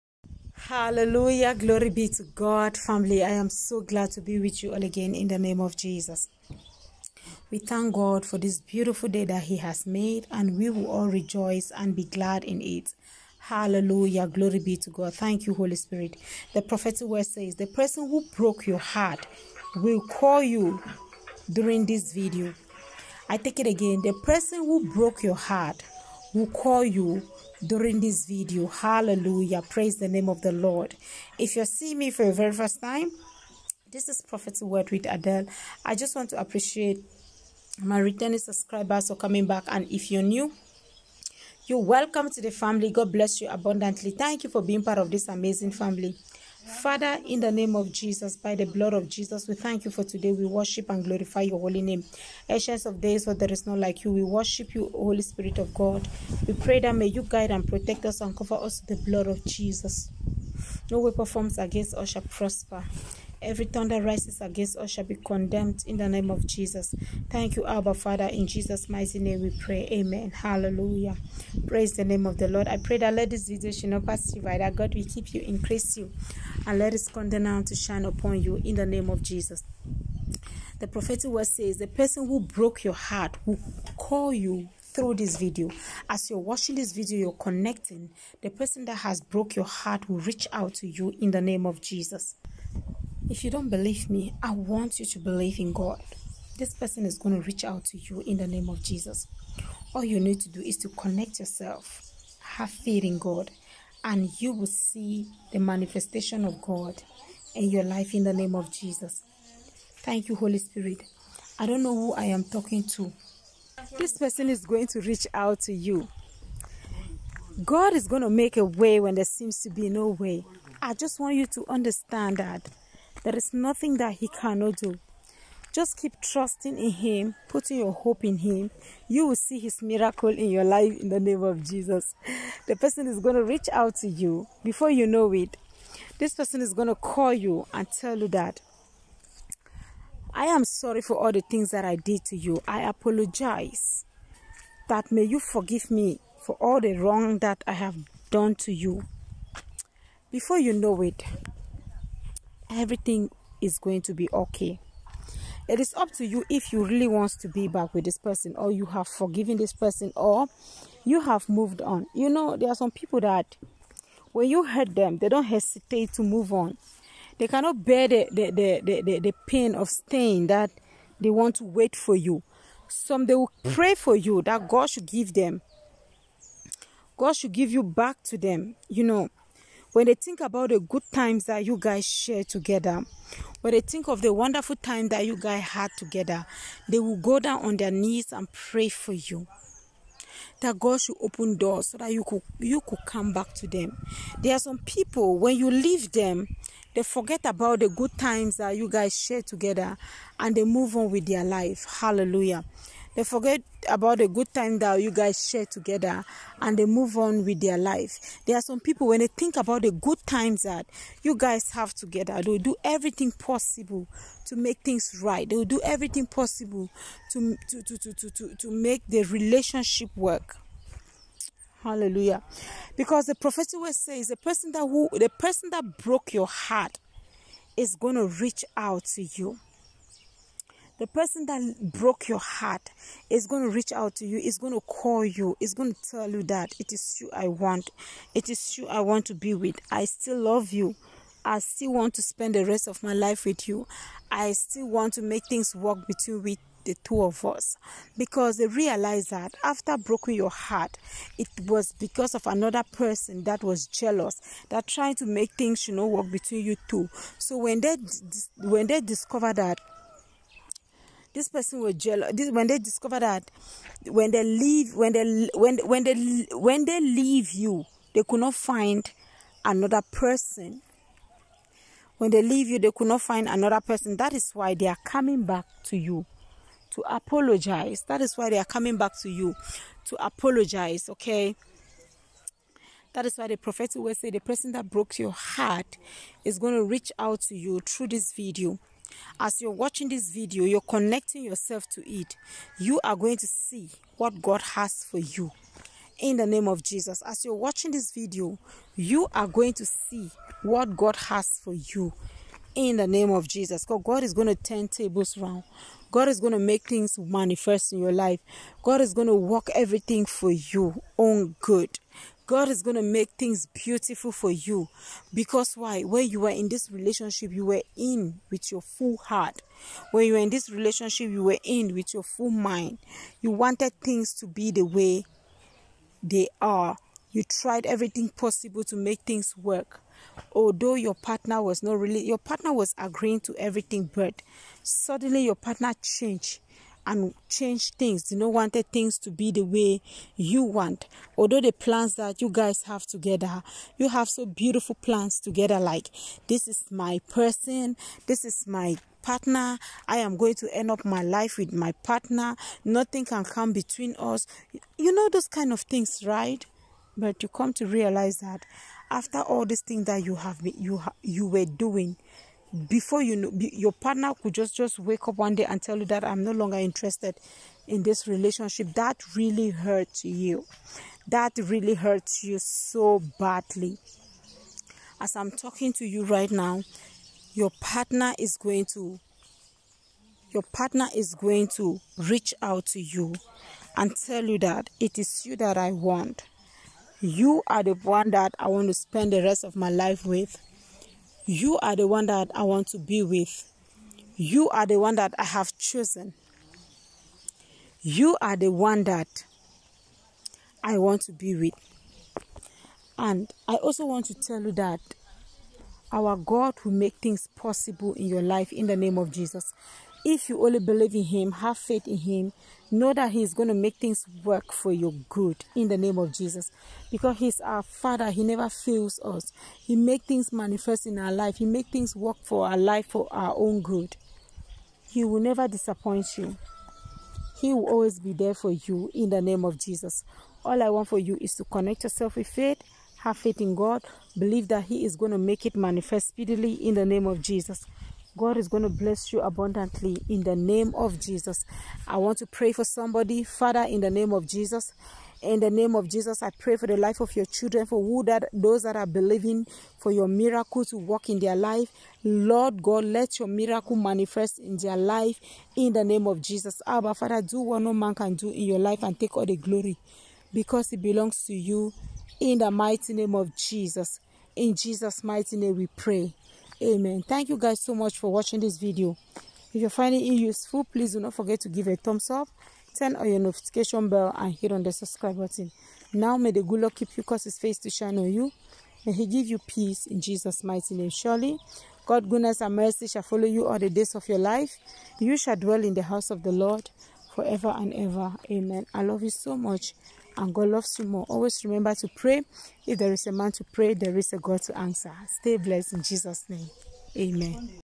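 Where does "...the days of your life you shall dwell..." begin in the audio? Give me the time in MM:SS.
08:03.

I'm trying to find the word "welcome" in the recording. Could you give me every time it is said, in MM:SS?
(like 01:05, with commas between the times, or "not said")
00:41.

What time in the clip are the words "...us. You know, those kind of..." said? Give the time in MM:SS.
05:54.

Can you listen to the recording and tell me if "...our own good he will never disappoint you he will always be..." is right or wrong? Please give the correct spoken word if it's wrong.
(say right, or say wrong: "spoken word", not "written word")
right.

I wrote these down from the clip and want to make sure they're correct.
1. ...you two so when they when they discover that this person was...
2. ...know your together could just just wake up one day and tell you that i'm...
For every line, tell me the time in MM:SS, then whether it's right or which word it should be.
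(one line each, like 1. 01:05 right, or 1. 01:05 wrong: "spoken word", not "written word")
1. 04:16 right
2. 06:03 wrong: "partner", not "together".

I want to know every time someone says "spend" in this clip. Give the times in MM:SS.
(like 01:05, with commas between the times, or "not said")
04:02, 06:28.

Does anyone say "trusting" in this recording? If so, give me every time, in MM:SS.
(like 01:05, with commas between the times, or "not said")
02:06.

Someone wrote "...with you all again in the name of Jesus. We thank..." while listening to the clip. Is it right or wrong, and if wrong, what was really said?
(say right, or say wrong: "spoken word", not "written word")
right.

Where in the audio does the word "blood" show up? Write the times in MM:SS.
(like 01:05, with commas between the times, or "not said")
00:48, 00:59.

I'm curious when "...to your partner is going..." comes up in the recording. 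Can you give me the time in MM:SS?
06:18.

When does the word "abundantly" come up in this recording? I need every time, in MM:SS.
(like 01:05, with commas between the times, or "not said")
00:43, 07:19.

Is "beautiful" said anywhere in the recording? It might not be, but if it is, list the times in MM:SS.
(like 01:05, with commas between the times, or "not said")
00:08, 05:13, 05:44.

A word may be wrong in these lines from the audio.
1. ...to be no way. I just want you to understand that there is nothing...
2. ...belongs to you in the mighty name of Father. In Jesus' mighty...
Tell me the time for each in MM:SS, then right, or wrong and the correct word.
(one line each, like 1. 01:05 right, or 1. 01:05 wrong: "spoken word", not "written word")
1. 01:59 right
2. 07:41 wrong: "Jesus", not "Father".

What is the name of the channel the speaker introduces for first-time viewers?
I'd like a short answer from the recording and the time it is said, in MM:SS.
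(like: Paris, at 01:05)
Prophetic Word with Adel, at 00:34.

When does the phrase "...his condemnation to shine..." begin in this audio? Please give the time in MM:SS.
01:16.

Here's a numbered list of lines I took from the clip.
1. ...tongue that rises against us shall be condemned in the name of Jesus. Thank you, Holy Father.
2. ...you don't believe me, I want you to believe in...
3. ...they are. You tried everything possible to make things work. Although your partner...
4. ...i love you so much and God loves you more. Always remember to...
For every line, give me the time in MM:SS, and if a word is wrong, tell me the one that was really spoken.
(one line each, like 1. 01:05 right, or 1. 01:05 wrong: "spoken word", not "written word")
1. 01:03 wrong: "Abba", not "Holy"
2. 01:33 right
3. 05:26 right
4. 08:08 right.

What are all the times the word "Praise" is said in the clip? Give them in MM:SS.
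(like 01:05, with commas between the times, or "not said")
00:29, 01:11.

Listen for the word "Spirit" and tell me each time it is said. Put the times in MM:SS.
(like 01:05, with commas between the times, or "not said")
00:15, 00:55, 01:50.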